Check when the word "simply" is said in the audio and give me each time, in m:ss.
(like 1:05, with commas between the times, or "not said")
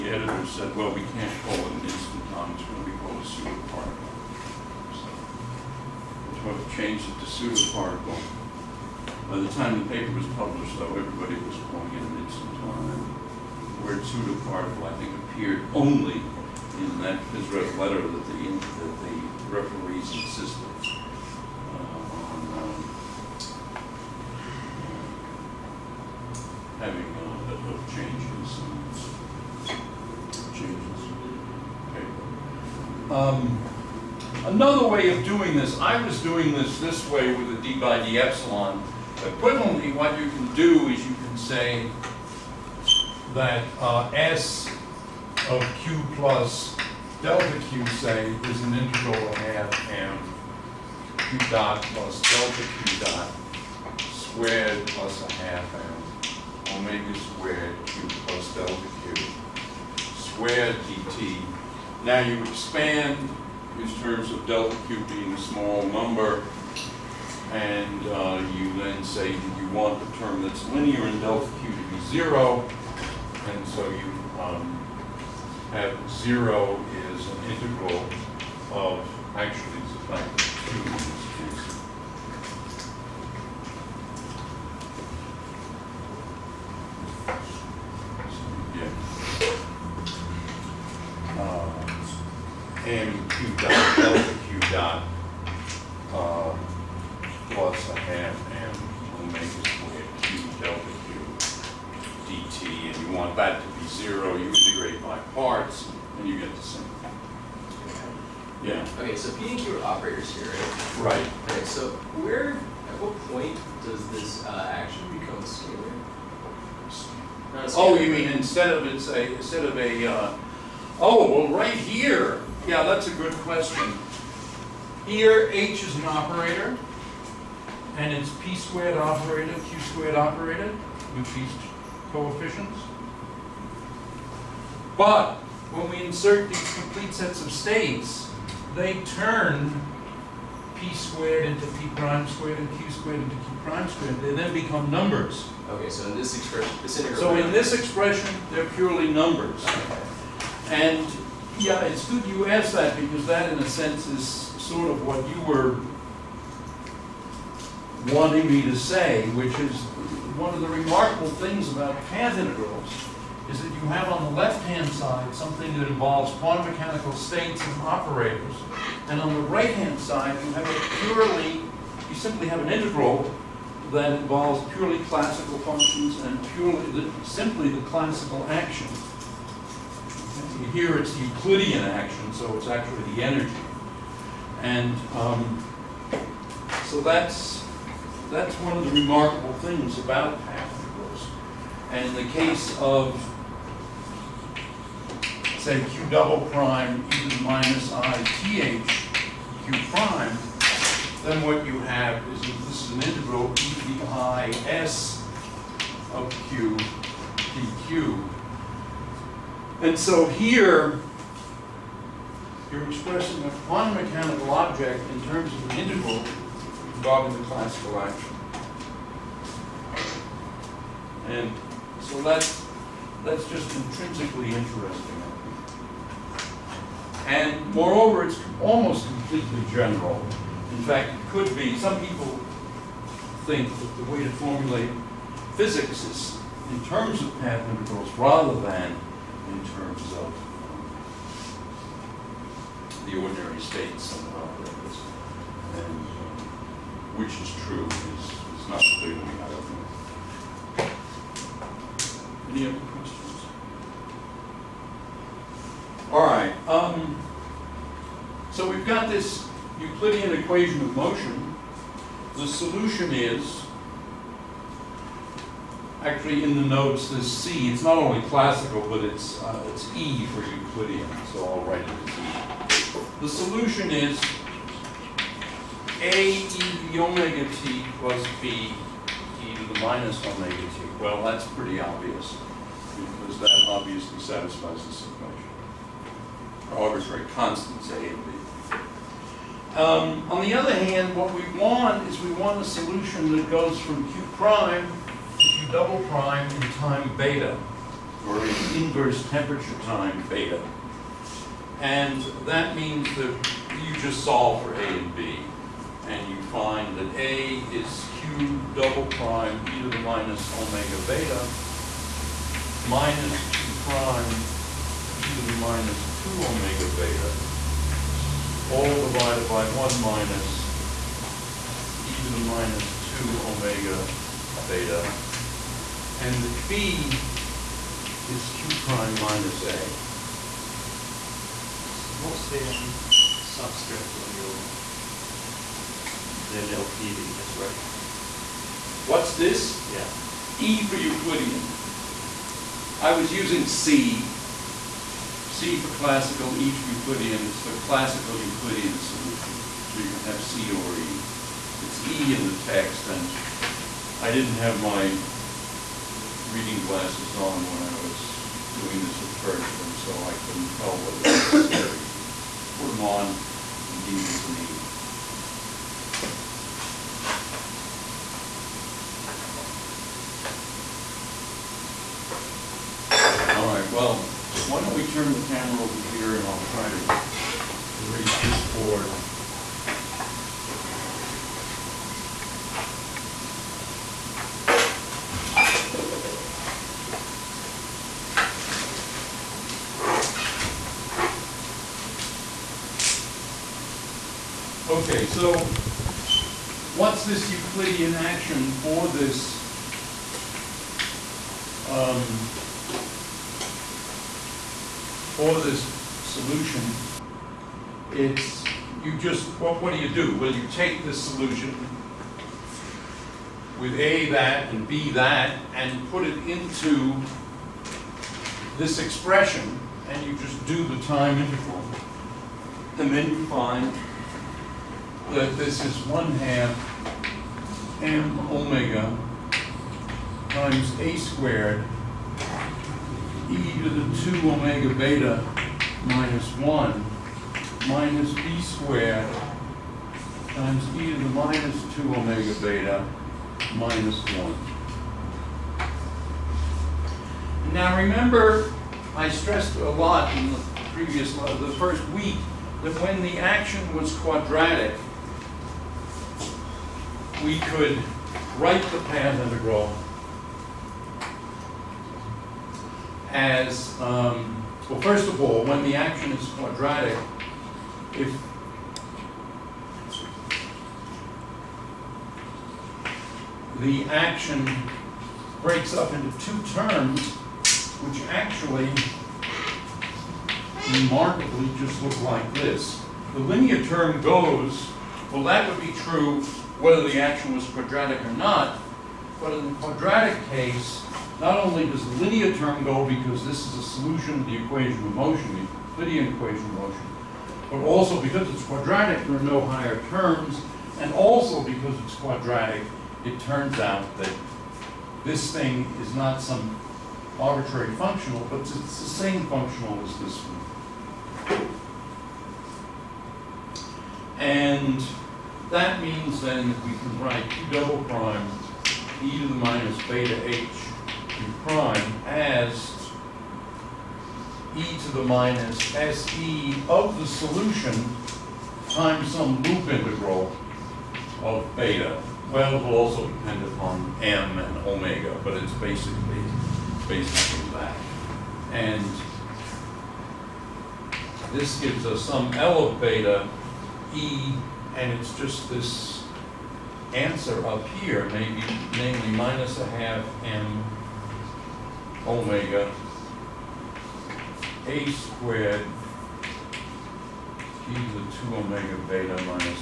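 2:52, 2:57.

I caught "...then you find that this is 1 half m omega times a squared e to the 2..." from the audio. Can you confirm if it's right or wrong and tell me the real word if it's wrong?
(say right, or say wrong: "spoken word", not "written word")
right.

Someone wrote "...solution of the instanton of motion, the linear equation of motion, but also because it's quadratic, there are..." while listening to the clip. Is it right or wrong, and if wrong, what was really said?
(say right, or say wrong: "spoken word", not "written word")
wrong: "equation", not "instanton".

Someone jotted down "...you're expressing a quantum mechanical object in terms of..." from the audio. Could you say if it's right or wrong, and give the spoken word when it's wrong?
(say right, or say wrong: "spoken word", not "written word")
right.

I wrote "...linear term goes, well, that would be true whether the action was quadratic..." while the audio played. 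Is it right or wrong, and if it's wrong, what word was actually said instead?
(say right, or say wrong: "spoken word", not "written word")
right.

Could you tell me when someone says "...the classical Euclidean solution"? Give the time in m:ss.
5:47.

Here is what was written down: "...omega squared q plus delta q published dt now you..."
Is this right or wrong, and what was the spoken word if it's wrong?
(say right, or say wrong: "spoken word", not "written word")
wrong: "squared", not "published".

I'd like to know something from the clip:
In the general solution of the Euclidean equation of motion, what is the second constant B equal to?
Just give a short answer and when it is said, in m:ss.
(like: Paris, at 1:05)
Q prime minus A, at 5:26.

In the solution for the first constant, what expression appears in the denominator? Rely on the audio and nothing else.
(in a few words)
1 minus e to the minus 2 omega beta.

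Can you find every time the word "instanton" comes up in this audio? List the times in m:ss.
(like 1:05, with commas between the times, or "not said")
0:01, 0:12.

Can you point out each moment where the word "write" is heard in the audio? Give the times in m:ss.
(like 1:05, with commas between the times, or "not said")
4:31, 7:38, 8:37.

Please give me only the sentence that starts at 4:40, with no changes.
Well, that's pretty obvious, because that obviously satisfies this equation.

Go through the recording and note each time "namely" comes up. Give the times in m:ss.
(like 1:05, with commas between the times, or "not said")
9:08.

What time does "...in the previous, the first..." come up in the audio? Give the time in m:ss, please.
7:30.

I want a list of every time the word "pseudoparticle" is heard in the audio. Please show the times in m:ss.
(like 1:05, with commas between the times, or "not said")
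0:03, 0:07, 0:14.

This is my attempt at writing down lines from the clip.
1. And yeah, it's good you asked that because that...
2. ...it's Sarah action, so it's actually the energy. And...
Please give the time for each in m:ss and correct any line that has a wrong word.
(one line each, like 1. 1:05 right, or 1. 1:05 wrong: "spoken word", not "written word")
1. 2:30 right
2. 3:00 wrong: "Euclidean", not "Sarah".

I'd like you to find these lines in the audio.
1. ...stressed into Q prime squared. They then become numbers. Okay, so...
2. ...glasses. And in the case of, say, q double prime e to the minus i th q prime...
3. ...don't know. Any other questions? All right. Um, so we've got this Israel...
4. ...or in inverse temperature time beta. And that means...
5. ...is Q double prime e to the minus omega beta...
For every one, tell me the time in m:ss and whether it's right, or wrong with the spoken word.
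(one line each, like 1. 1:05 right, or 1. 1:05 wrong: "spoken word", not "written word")
1. 2:22 wrong: "squared", not "stressed"
2. 3:10 wrong: "particles", not "glasses"
3. 4:09 wrong: "Euclidean", not "Israel"
4. 4:58 right
5. 5:07 right.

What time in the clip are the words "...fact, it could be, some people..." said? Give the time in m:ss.
3:50.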